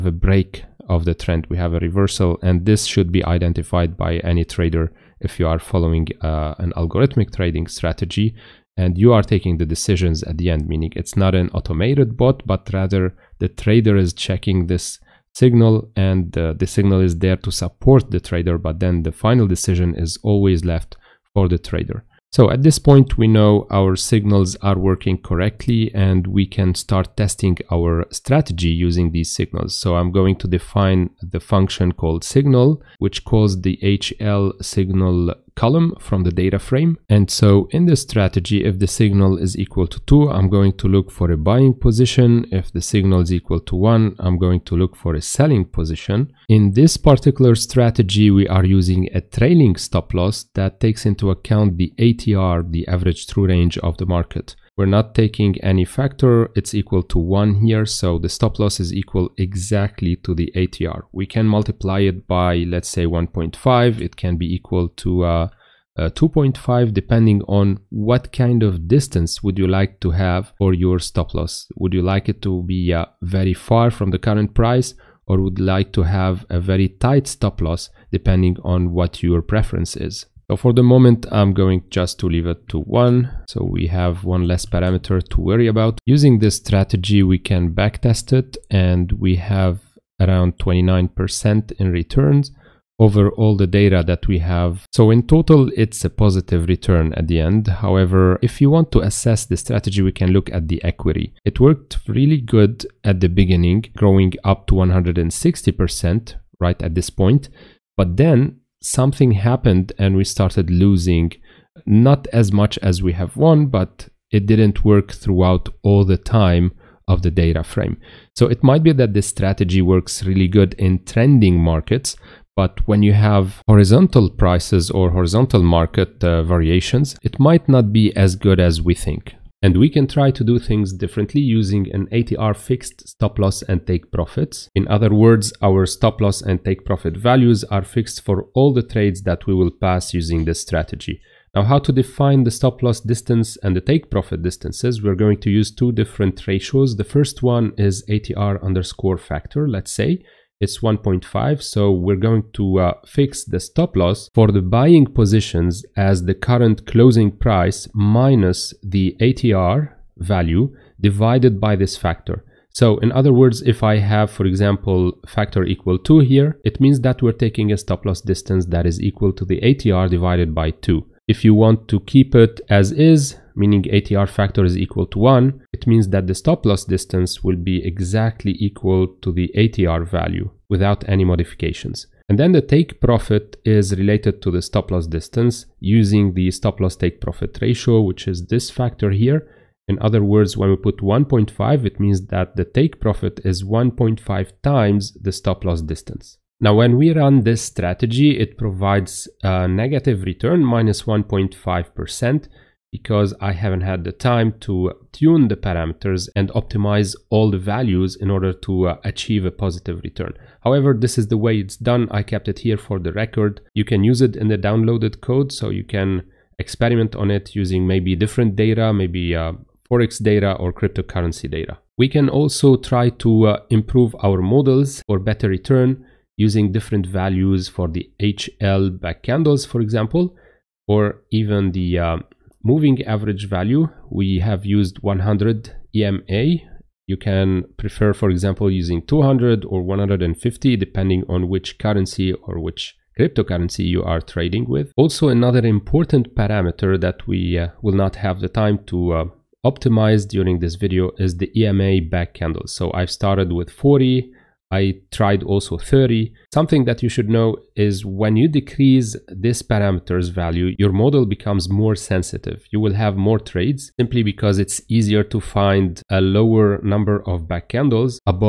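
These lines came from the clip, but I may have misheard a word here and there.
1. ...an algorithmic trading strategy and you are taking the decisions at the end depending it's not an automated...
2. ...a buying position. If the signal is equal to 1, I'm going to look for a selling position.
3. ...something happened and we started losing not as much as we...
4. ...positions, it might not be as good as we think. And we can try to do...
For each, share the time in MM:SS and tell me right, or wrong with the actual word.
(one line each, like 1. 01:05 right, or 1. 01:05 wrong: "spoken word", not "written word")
1. 00:06 wrong: "meaning", not "depending"
2. 00:41 right
3. 01:48 right
4. 02:06 wrong: "variations", not "positions".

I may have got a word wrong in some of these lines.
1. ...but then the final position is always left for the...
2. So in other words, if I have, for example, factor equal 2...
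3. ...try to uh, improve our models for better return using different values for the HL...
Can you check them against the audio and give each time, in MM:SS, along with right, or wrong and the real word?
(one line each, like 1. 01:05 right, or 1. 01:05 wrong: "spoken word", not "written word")
1. 00:18 wrong: "decision", not "position"
2. 02:42 right
3. 03:42 right.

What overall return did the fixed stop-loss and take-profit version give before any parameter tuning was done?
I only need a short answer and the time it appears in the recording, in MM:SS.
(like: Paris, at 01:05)
-1.5%, at 03:20.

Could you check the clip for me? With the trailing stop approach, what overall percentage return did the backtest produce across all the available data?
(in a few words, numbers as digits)
29%.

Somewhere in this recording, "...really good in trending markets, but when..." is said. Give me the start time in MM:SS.
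02:00.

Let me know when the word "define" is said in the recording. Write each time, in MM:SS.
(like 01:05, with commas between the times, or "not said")
00:30, 02:21.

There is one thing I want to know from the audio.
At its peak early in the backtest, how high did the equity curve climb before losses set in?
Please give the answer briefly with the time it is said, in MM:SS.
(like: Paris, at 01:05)
160%, at 01:44.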